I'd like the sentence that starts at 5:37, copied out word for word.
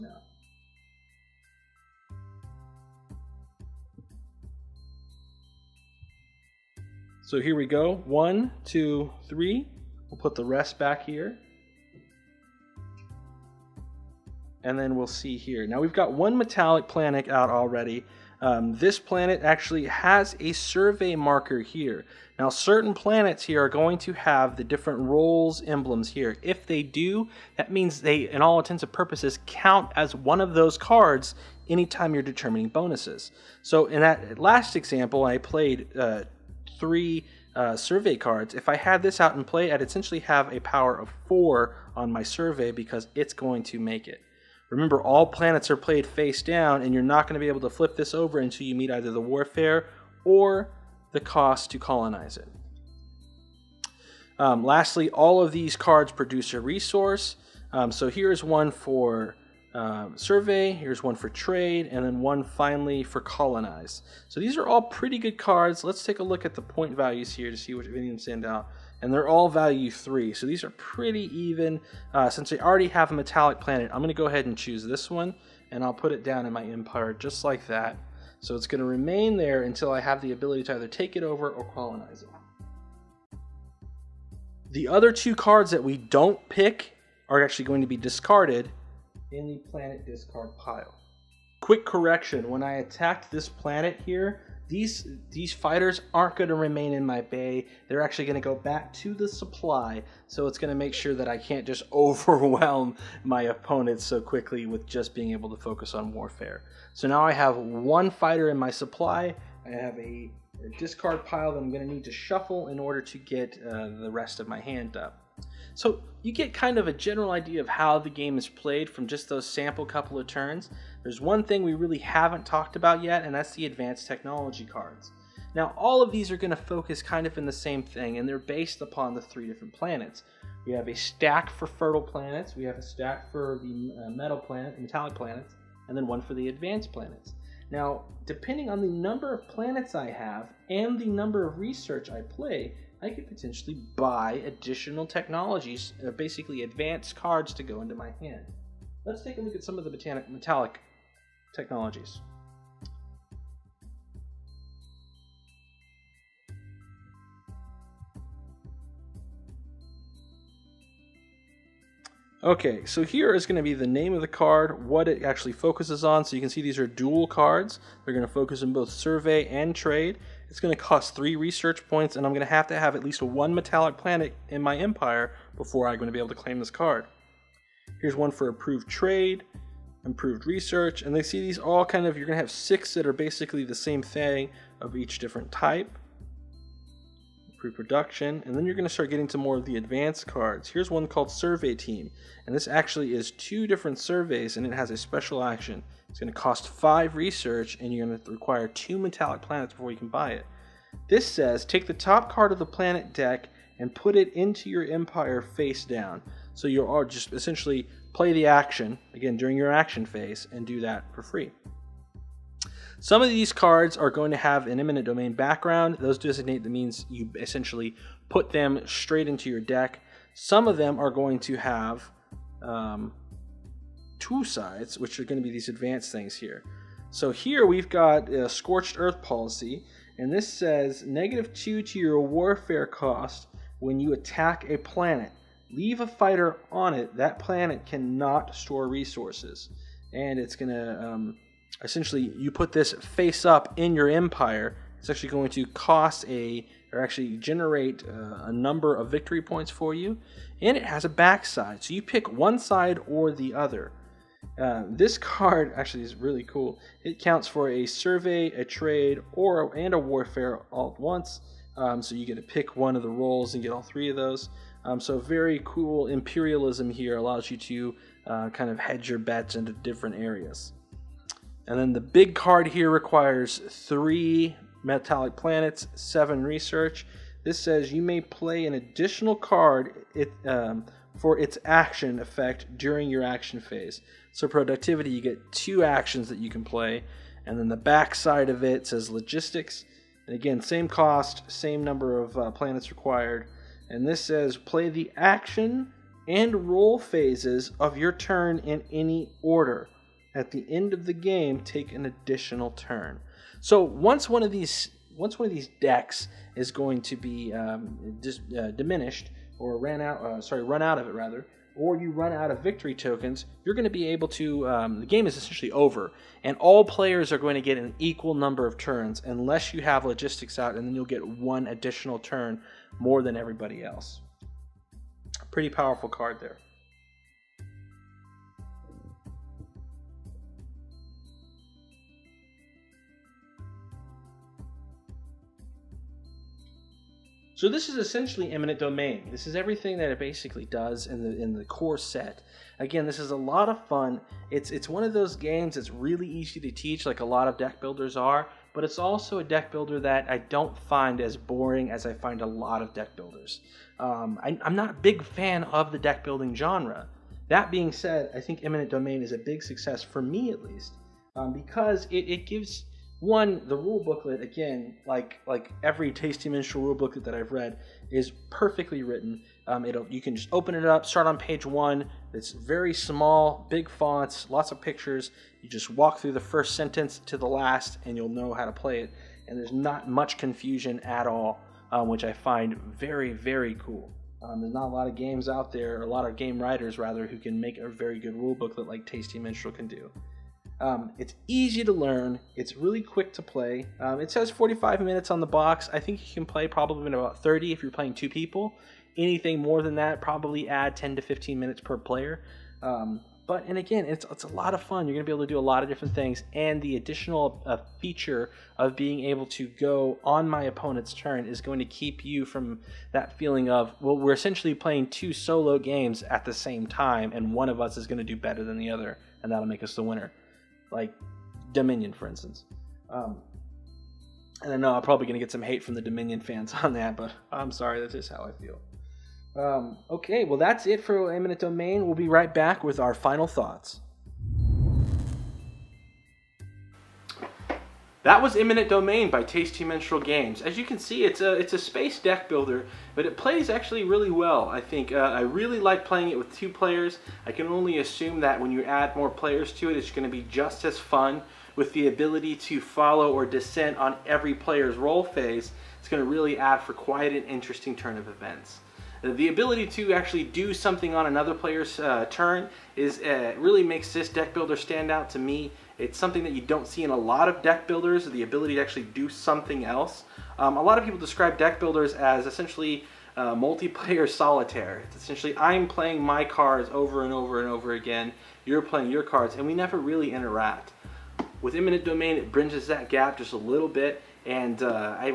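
So this is essentially eminent domain.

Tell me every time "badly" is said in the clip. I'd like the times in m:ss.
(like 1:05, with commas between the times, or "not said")
not said.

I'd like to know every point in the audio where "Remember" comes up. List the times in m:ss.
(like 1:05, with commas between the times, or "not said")
0:44.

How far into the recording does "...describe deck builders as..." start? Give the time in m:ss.
7:51.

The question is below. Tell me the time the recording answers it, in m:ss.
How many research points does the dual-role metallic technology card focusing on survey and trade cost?
2:51.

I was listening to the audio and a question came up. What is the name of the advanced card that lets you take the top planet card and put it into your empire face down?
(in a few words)
Survey Team.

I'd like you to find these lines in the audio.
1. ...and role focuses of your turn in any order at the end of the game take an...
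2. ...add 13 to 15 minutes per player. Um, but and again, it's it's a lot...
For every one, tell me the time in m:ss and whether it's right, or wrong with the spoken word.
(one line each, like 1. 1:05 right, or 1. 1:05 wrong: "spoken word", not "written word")
1. 4:56 wrong: "phases", not "focuses"
2. 6:40 wrong: "10", not "13".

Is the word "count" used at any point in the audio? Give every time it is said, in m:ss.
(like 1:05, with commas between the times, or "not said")
0:29, 4:17.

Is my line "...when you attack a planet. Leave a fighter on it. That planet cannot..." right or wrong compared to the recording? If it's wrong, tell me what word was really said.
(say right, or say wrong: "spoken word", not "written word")
right.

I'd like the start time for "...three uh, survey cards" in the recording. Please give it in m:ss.
0:36.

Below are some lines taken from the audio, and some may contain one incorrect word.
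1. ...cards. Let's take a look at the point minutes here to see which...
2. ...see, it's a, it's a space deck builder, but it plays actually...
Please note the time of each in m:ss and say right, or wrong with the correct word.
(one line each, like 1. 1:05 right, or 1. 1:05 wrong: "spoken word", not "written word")
1. 1:05 wrong: "values", not "minutes"
2. 7:20 right.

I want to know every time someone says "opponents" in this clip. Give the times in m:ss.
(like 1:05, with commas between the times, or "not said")
1:43, 6:50.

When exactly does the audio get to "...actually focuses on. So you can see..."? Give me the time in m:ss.
2:45.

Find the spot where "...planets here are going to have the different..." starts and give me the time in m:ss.
0:22.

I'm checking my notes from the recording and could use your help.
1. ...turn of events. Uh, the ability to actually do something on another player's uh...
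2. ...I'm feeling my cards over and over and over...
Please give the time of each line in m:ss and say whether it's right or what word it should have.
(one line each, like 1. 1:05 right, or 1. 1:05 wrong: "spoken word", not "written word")
1. 7:37 right
2. 7:55 wrong: "playing", not "feeling".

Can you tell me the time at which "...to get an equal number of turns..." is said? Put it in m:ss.
5:17.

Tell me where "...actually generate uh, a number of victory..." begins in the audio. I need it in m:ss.
4:07.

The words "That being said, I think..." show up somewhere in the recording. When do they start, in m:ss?
5:57.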